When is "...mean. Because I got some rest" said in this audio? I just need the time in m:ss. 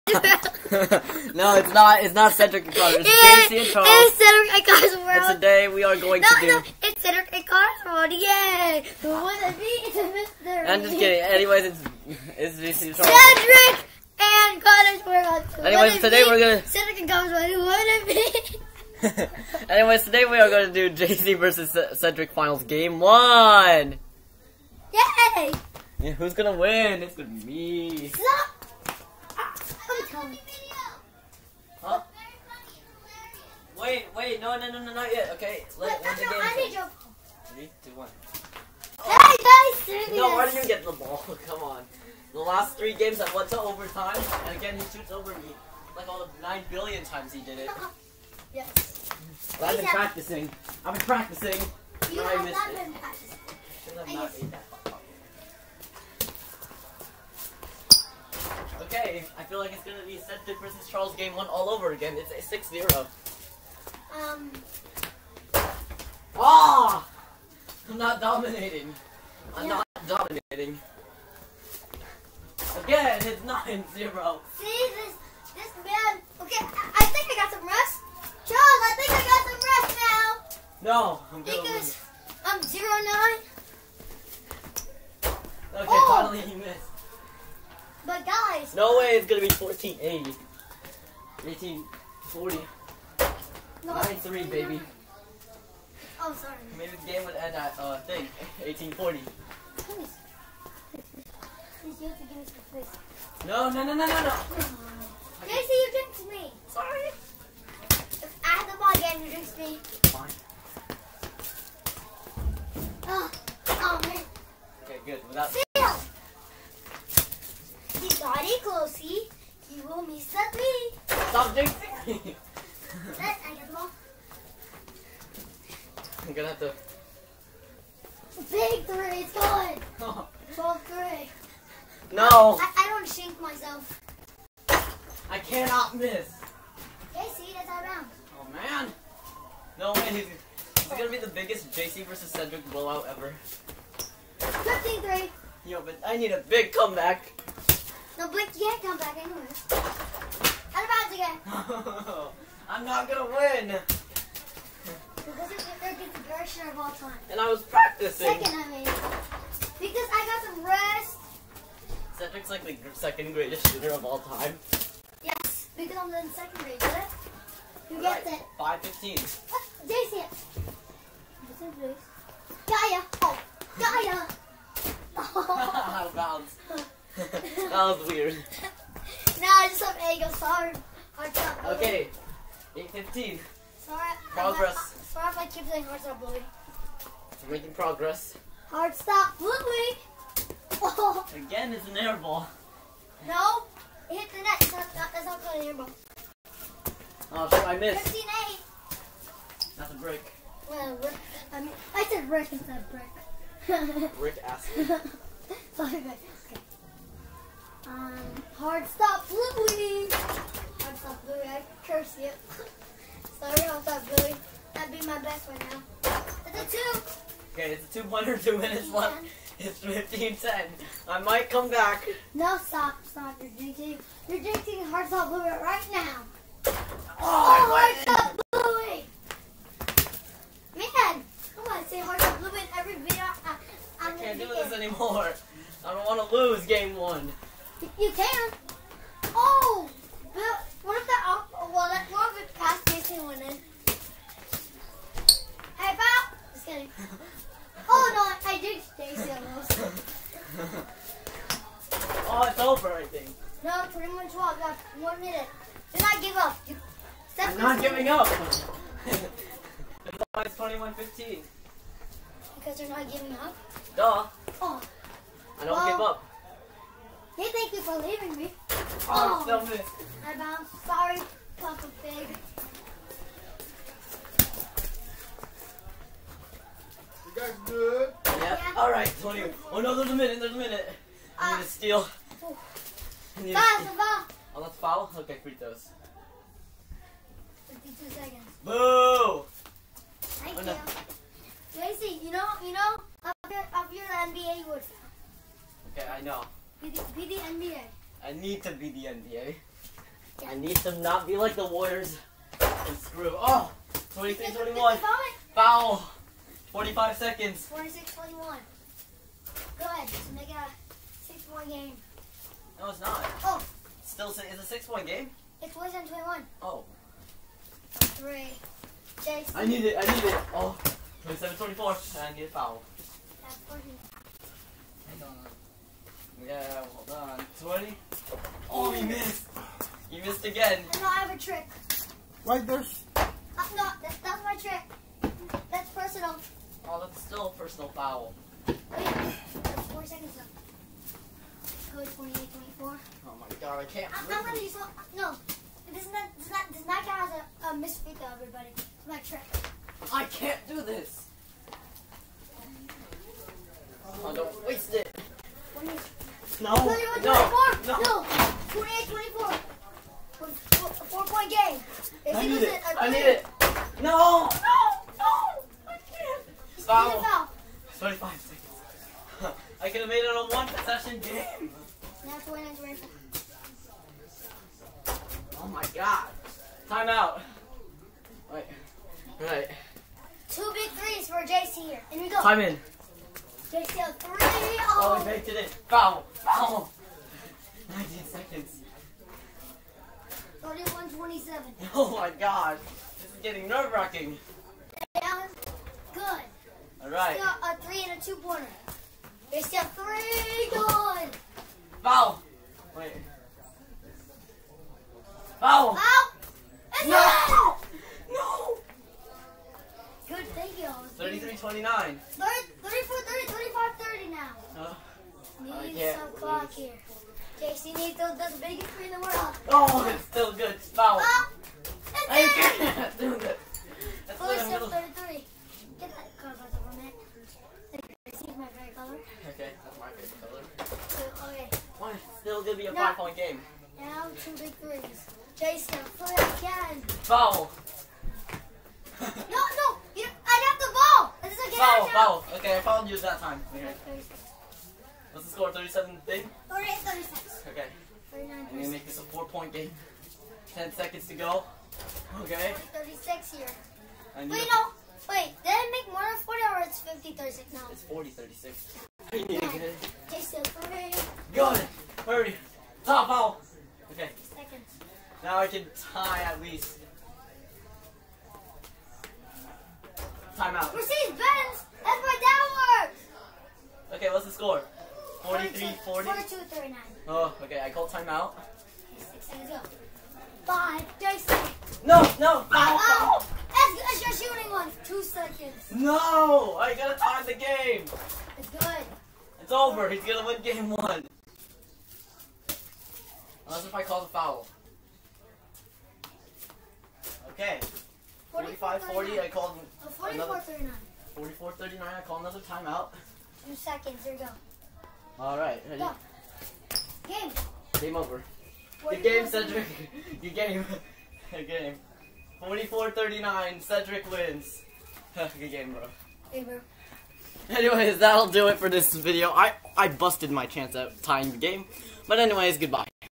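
2:38.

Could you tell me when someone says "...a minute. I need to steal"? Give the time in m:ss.
4:40.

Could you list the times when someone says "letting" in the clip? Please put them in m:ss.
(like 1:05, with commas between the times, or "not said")
5:44.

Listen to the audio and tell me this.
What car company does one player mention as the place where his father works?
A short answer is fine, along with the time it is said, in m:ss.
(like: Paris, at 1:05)
Mercedes Benz, at 7:50.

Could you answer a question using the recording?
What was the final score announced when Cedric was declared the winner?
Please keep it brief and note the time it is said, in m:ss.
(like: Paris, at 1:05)
44-39, at 8:32.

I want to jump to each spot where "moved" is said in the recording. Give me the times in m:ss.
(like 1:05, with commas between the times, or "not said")
not said.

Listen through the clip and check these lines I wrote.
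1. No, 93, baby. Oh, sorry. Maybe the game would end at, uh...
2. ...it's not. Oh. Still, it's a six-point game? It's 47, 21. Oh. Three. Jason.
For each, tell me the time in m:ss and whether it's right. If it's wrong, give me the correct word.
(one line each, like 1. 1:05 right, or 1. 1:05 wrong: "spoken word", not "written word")
1. 1:33 right
2. 5:12 right.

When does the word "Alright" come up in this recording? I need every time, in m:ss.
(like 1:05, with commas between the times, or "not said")
8:25.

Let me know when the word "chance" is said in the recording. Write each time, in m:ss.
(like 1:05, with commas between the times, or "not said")
8:40.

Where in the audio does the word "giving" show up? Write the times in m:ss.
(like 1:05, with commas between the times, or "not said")
4:17, 4:23.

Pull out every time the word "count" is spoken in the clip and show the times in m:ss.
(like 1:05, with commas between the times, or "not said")
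5:47.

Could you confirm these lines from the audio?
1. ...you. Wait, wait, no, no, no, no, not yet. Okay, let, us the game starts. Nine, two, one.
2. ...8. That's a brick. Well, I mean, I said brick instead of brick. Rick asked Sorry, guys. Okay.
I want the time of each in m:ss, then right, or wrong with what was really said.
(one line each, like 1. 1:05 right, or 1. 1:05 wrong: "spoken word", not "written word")
1. 0:30 wrong: "Three", not "Nine"
2. 3:18 right.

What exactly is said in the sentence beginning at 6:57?
JC needs the, biggest three in the world.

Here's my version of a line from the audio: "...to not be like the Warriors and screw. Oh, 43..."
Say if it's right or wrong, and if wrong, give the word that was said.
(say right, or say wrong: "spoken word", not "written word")
wrong: "23", not "43".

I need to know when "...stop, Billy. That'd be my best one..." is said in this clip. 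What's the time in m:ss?
3:33.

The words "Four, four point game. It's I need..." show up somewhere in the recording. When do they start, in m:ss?
6:00.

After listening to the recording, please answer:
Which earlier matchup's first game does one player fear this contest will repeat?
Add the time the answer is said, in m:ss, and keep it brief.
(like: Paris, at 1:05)
Seth versus Charles, at 1:00.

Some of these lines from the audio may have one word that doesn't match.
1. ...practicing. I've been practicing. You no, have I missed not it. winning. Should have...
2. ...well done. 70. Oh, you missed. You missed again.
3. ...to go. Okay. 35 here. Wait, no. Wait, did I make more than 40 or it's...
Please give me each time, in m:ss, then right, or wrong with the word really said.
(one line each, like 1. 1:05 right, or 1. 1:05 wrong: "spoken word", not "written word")
1. 0:49 wrong: "practicing", not "winning"
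2. 5:26 wrong: "20", not "70"
3. 7:31 wrong: "36", not "35".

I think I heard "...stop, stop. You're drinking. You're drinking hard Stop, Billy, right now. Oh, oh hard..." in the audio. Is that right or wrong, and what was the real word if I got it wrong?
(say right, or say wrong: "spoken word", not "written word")
right.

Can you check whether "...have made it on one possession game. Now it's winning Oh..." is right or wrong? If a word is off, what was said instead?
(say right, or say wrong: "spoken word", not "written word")
right.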